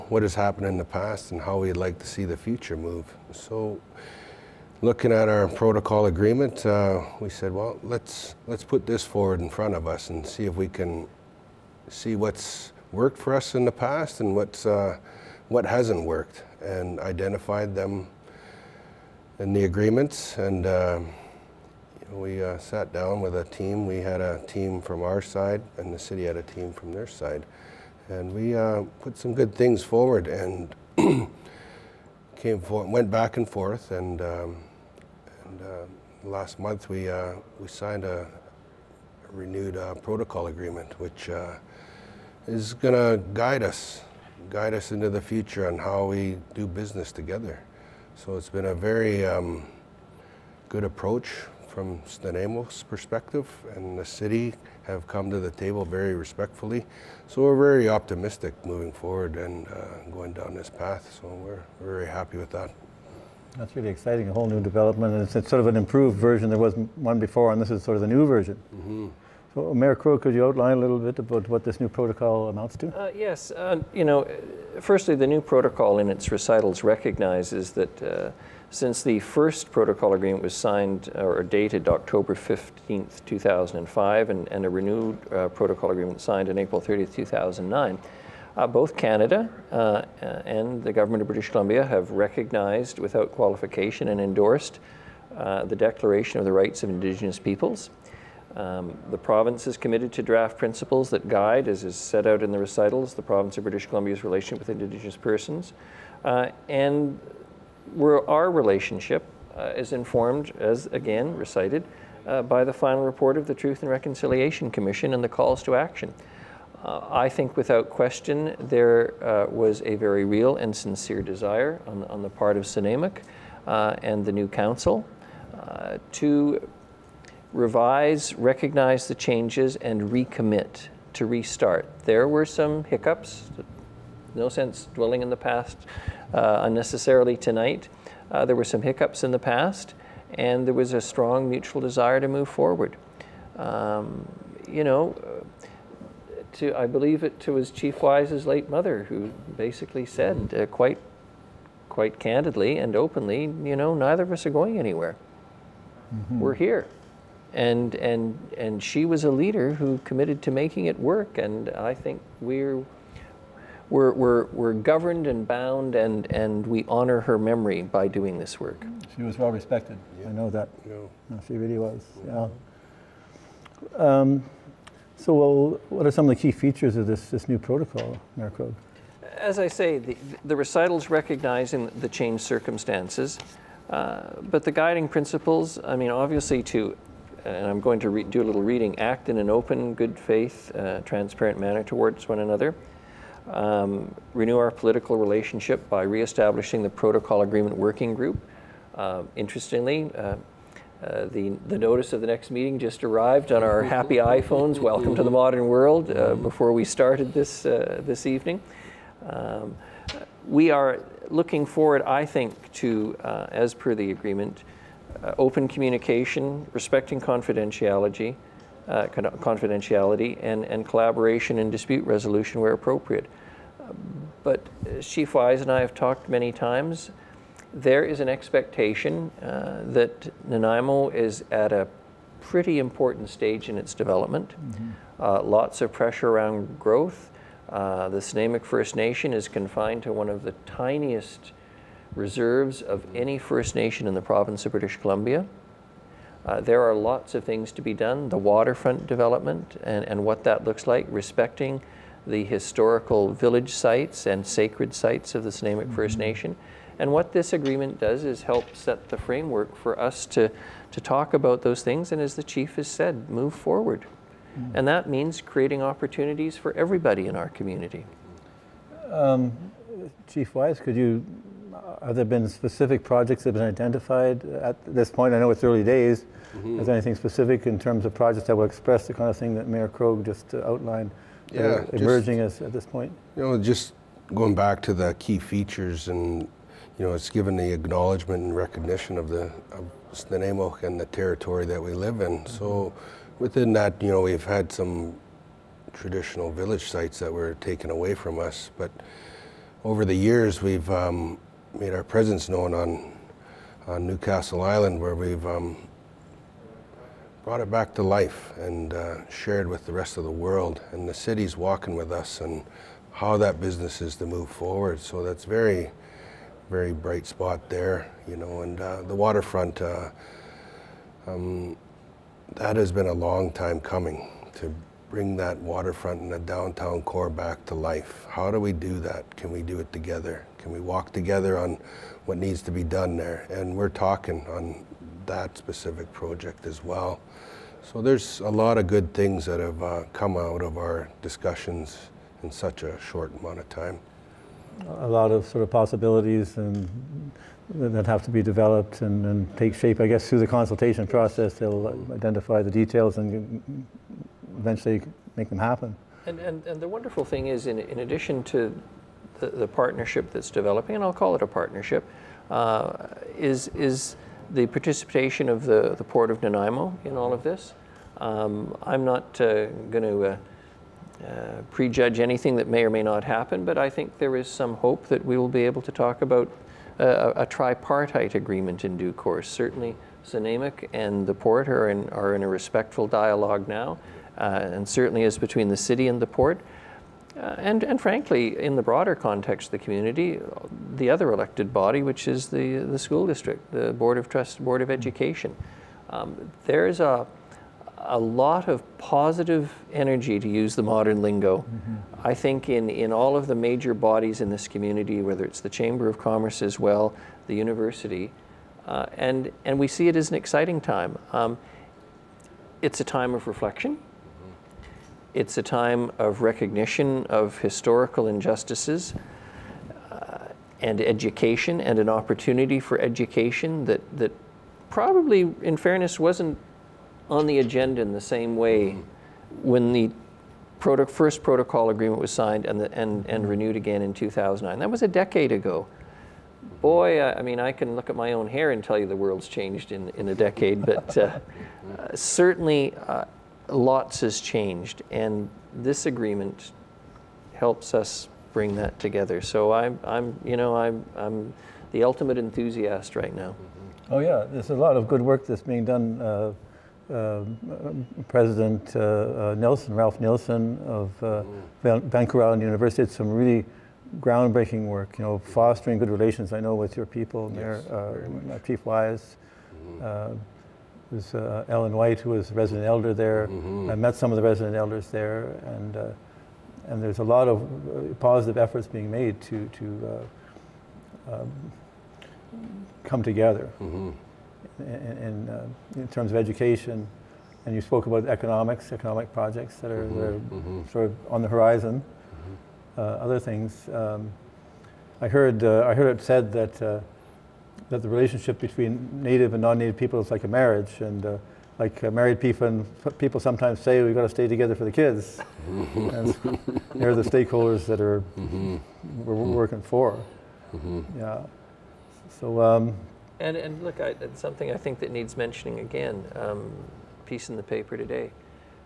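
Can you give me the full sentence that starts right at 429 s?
when the proto first protocol agreement was signed and, the, and, and mm-hmm.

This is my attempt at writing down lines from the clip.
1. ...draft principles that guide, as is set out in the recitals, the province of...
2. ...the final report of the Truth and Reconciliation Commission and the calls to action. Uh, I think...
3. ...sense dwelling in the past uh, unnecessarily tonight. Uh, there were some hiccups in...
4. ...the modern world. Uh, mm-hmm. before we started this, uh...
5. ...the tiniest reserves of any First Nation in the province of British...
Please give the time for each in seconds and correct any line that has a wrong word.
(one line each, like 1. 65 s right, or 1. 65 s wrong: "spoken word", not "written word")
1. 100 s right
2. 112 s right
3. 134 s right
4. 205 s right
5. 240 s right.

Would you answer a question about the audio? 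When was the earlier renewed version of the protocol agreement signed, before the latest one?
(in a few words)
April 30, 2009.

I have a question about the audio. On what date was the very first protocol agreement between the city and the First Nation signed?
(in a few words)
October 15, 2005.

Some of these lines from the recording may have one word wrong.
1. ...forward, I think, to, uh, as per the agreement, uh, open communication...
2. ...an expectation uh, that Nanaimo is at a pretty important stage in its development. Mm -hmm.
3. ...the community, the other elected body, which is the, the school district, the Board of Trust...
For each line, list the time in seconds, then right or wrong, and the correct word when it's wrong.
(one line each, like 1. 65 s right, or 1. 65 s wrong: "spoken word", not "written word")
1. 211 s right
2. 228 s right
3. 389 s right.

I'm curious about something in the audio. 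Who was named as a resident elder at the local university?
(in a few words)
Ellen White.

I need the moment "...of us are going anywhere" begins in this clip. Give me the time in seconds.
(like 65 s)
154 s.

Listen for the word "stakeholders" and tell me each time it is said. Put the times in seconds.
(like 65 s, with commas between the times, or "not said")
507 s.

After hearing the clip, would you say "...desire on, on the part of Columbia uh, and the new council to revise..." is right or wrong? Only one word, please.
wrong.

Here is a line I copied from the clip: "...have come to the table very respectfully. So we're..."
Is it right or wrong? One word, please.
right.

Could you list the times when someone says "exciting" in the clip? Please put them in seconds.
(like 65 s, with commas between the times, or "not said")
63 s, 410 s.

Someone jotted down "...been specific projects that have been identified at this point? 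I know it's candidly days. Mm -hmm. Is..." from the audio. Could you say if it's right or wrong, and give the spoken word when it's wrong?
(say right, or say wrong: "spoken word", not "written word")
wrong: "early", not "candidly".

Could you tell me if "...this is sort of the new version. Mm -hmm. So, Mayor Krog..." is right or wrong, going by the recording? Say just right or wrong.
right.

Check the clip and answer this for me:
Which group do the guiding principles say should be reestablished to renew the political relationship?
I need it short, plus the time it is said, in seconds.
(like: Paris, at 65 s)
Protocol Agreement Working Group, at 196 s.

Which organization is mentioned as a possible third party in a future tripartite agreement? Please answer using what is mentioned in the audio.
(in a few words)
Port of Nanaimo.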